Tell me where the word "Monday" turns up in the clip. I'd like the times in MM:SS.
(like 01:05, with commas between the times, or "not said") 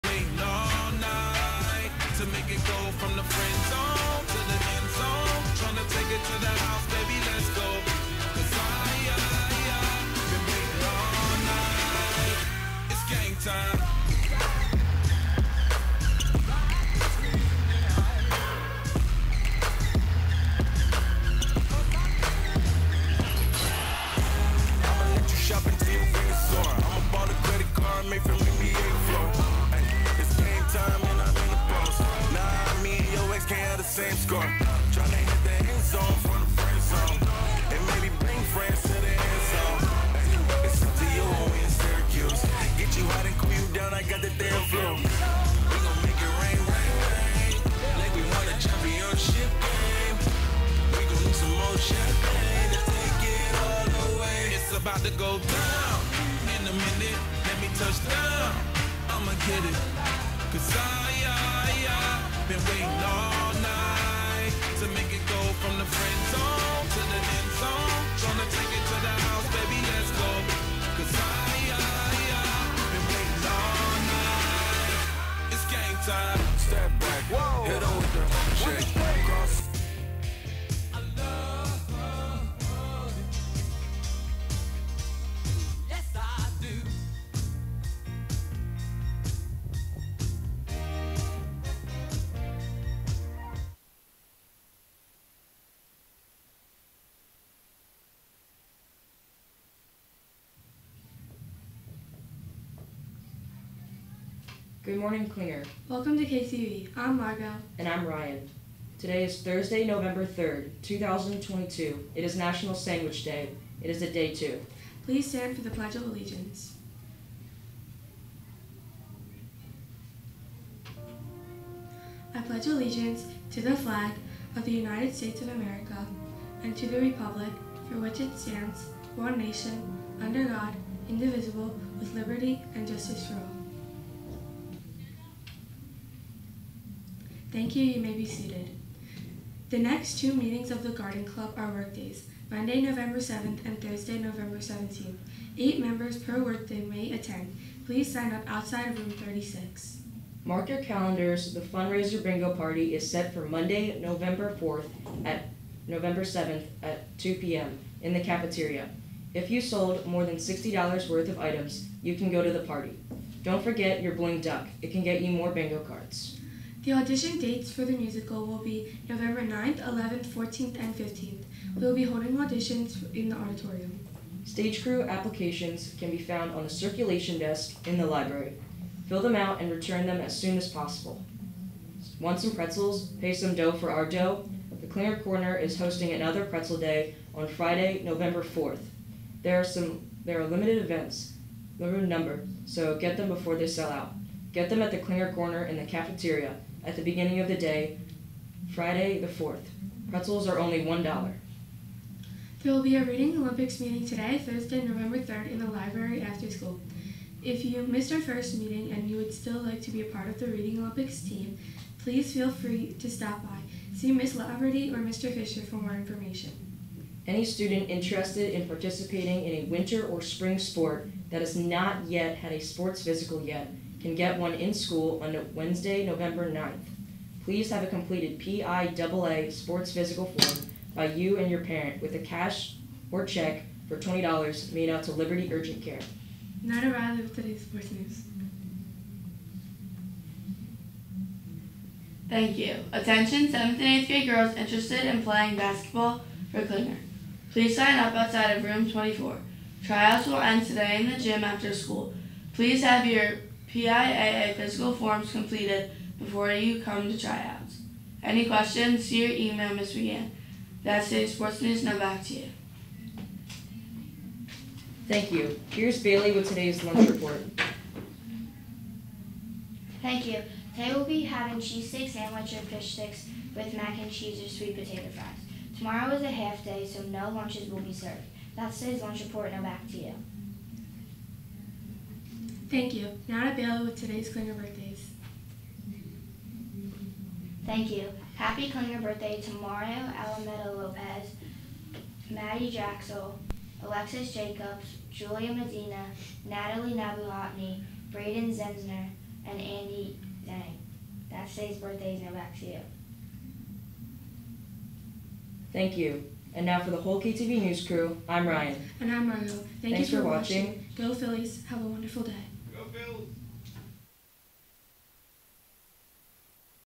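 02:22, 02:33.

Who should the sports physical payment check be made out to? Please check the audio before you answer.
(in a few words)
Liberty Urgent Care.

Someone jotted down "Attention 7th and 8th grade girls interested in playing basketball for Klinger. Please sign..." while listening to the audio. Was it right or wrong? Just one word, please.
right.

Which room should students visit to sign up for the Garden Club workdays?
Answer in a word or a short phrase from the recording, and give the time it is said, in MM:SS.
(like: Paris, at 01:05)
Room 36, at 02:28.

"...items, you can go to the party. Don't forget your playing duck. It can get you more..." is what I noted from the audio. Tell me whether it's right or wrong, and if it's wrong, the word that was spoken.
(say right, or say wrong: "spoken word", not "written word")
wrong: "bling", not "playing".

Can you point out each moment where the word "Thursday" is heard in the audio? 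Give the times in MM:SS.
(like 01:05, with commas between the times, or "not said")
01:49, 02:23, 03:24.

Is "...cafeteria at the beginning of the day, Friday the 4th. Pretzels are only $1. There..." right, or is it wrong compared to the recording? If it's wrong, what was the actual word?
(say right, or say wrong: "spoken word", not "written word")
right.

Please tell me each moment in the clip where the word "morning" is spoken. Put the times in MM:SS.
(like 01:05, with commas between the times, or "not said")
01:44.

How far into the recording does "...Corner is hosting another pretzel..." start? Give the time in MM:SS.
03:05.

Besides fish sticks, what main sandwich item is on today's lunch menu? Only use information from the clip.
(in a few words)
Cheese steak sandwich.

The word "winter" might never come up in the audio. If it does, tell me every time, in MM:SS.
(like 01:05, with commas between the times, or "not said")
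03:39.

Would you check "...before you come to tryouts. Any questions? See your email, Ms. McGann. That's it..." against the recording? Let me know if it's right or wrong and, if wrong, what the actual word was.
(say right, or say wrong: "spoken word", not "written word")
right.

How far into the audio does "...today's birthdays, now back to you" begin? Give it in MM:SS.
05:01.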